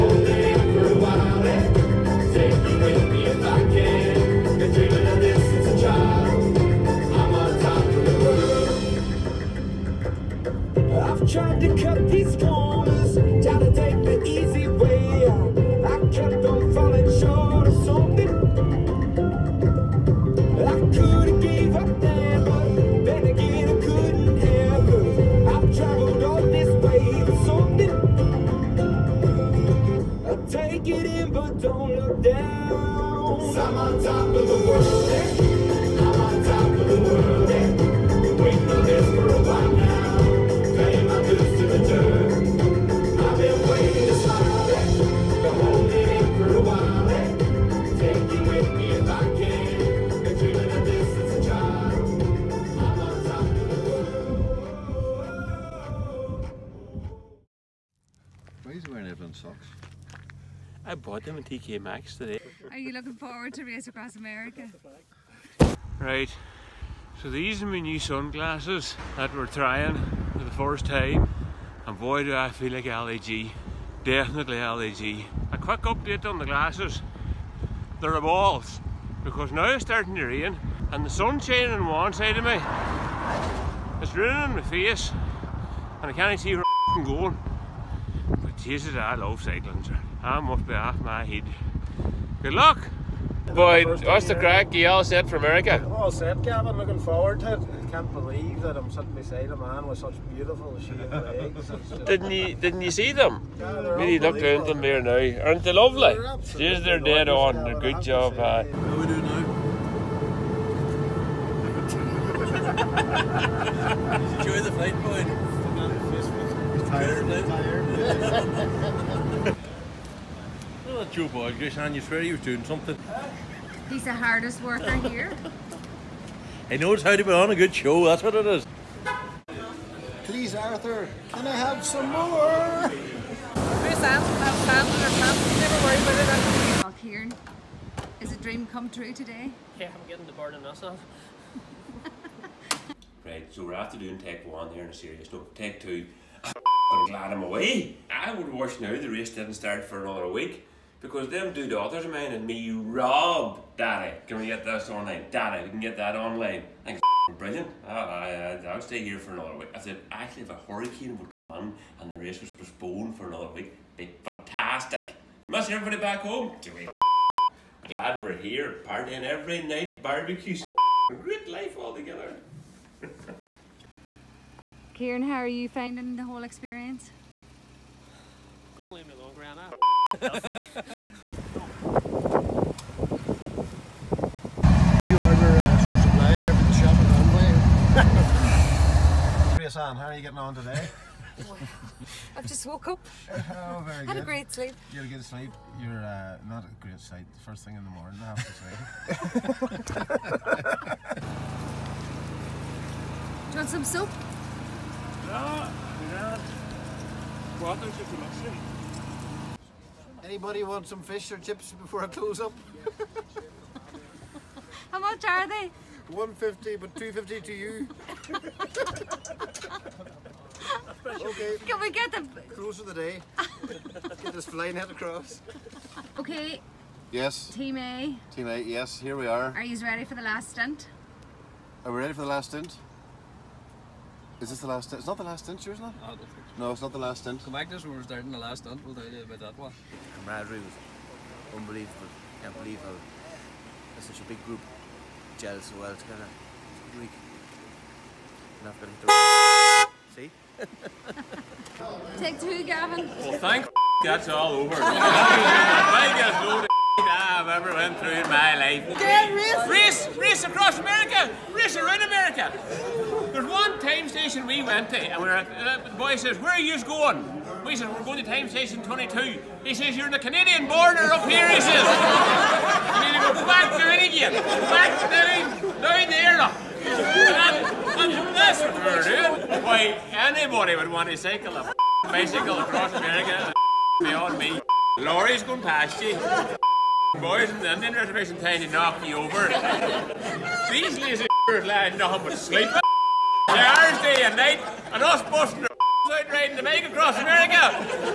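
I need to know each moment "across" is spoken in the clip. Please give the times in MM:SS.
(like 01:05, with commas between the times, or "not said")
01:03, 03:44, 04:20, 04:42, 04:56.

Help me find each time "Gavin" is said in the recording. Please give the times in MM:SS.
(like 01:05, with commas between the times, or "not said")
01:36, 01:47, 04:12.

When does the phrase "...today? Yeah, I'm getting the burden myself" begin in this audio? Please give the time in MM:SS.
02:19.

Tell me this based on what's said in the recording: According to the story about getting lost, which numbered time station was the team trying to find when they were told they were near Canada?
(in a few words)
22.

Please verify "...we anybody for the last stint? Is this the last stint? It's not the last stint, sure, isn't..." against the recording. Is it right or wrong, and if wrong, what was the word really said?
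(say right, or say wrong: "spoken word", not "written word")
wrong: "ready", not "anybody".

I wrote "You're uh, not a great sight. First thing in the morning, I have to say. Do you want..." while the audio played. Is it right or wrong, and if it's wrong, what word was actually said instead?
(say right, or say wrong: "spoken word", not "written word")
right.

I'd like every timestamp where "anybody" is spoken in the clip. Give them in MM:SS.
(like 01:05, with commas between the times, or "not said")
03:30, 04:40.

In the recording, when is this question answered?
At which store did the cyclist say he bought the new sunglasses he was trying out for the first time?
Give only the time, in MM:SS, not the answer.
01:01.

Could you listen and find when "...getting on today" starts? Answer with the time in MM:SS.
03:10.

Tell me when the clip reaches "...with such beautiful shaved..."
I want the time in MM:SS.
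01:39.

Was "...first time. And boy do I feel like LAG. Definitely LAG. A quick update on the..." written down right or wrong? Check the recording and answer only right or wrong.
right.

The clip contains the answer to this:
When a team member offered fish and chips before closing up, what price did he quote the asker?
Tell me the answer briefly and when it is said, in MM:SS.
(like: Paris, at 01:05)
250, at 03:36.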